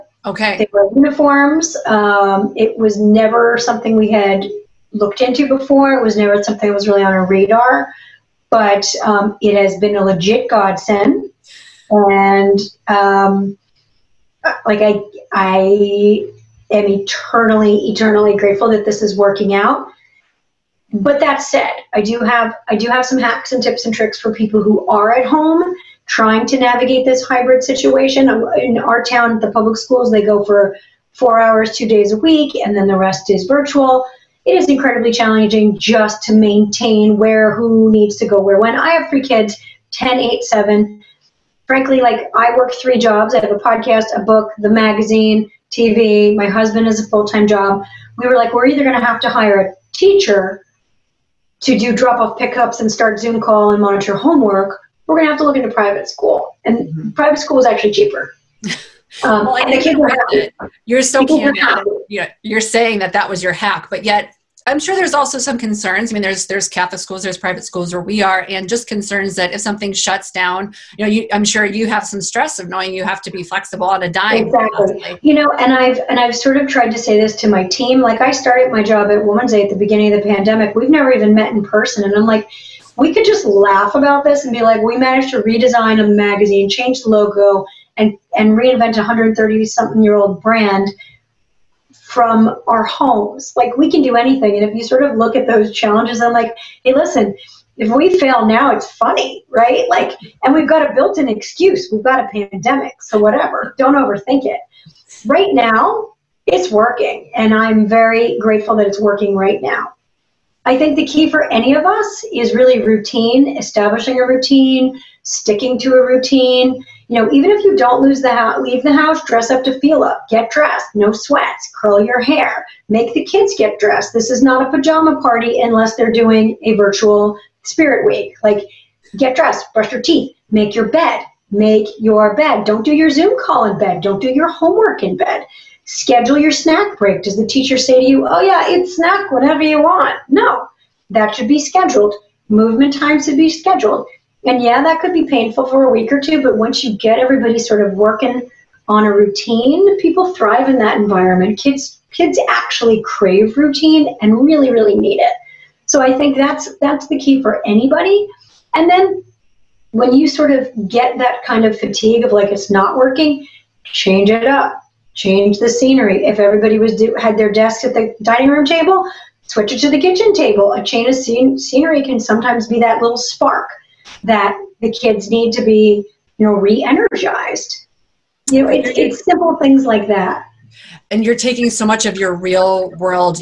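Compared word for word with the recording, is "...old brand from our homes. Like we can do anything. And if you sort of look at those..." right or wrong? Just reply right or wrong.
right.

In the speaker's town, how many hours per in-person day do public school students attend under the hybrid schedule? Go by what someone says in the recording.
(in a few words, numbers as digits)
4 hours.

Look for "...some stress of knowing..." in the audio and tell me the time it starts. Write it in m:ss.
1:12.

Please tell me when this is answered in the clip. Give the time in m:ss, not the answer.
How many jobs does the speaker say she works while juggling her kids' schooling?
0:42.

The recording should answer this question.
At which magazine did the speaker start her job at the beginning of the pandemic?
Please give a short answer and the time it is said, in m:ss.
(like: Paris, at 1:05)
Woman's Day, at 1:19.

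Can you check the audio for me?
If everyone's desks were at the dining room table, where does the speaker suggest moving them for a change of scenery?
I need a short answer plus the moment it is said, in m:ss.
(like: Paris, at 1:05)
Kitchen table, at 2:50.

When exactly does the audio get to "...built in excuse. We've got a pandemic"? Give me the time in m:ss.
1:40.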